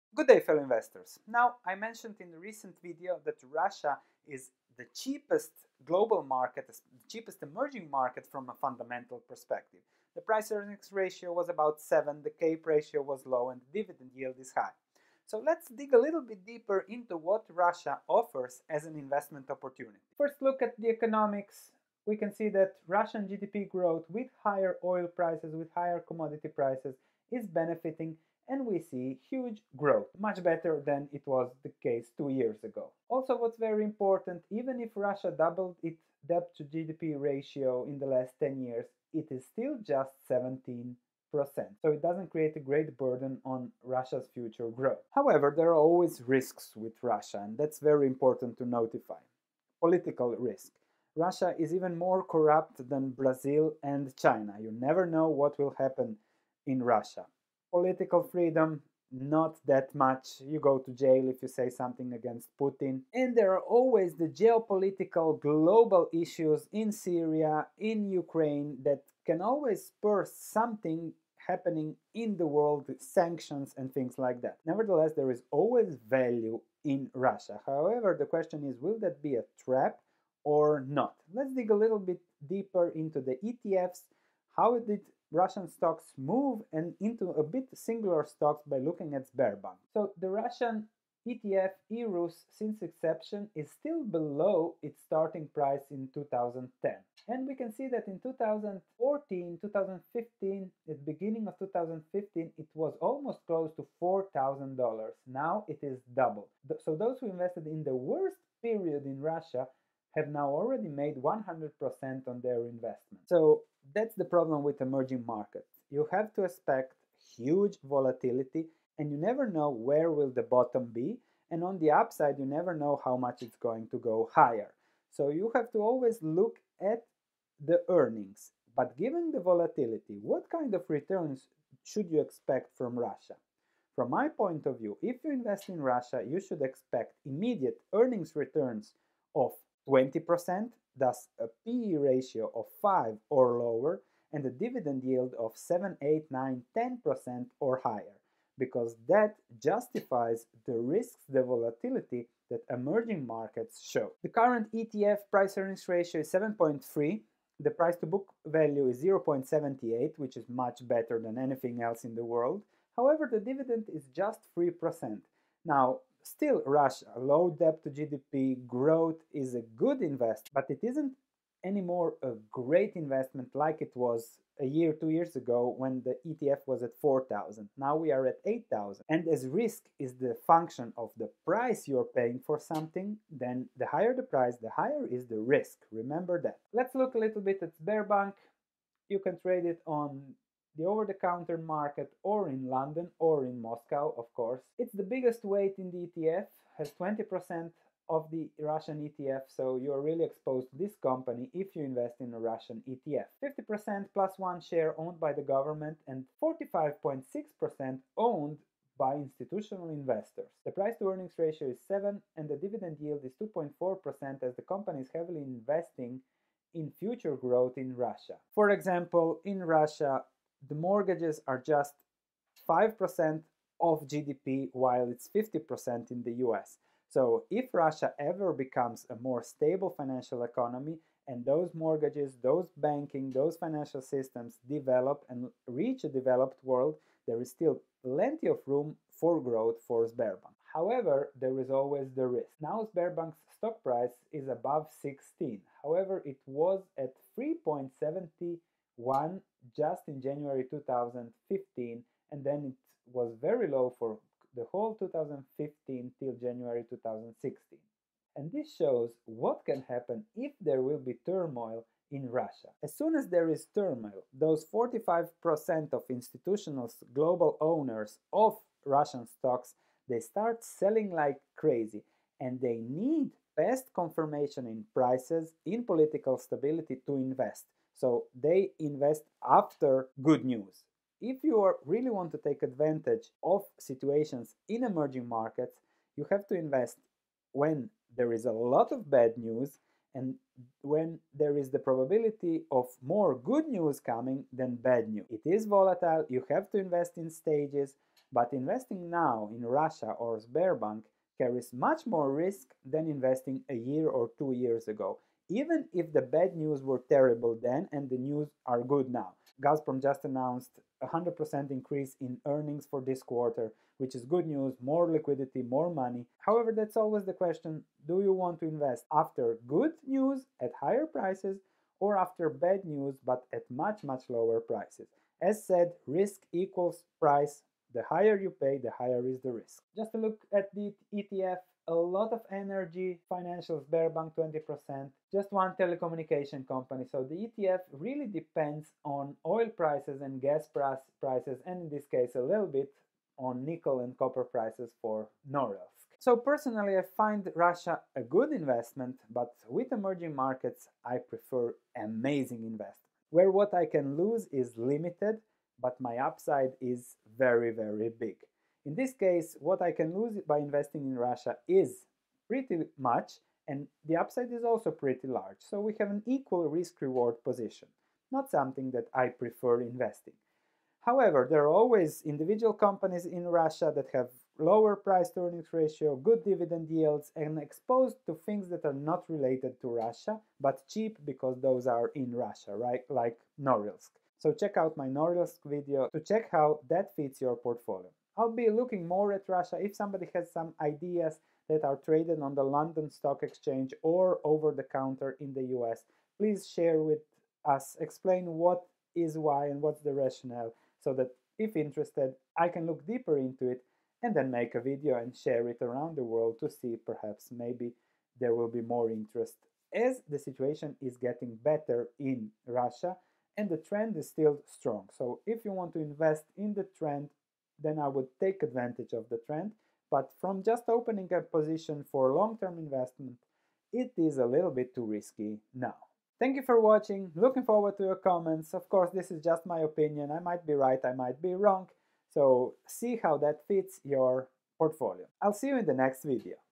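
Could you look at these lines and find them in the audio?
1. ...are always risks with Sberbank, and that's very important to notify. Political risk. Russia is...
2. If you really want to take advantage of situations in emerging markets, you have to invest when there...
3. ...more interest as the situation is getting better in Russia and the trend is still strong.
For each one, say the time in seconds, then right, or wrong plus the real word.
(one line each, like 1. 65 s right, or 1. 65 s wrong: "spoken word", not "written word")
1. 45 s wrong: "Russia", not "Sberbank"
2. 281 s right
3. 408 s right.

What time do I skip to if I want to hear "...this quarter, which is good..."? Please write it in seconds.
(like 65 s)
313 s.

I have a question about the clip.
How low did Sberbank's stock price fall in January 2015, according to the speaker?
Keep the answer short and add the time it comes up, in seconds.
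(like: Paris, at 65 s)
3.71, at 247 s.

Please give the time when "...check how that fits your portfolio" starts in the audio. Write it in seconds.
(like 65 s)
386 s.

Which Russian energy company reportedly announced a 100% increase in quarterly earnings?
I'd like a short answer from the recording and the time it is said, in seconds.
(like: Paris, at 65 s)
Gazprom, at 309 s.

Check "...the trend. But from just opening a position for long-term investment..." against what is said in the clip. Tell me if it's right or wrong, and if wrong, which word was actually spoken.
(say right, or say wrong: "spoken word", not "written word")
right.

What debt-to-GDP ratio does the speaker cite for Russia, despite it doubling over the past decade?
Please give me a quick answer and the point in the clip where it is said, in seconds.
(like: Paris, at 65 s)
17%, at 40 s.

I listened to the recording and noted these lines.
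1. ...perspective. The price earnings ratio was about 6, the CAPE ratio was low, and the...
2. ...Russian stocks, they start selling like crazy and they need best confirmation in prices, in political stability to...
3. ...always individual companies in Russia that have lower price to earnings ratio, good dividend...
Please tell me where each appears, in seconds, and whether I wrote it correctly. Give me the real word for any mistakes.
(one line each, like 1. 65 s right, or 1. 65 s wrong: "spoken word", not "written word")
1. 9 s wrong: "7", not "6"
2. 268 s right
3. 371 s right.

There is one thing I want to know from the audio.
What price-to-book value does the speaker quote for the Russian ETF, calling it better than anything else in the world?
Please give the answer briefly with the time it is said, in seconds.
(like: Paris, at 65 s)
0.78, at 159 s.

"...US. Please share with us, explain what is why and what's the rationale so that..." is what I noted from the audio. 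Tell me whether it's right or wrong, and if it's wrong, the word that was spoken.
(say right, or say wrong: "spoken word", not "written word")
right.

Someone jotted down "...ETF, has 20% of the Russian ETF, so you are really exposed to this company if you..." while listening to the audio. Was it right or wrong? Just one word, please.
right.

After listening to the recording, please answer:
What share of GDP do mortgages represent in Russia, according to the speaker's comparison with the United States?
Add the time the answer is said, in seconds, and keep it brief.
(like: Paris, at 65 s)
5%, at 222 s.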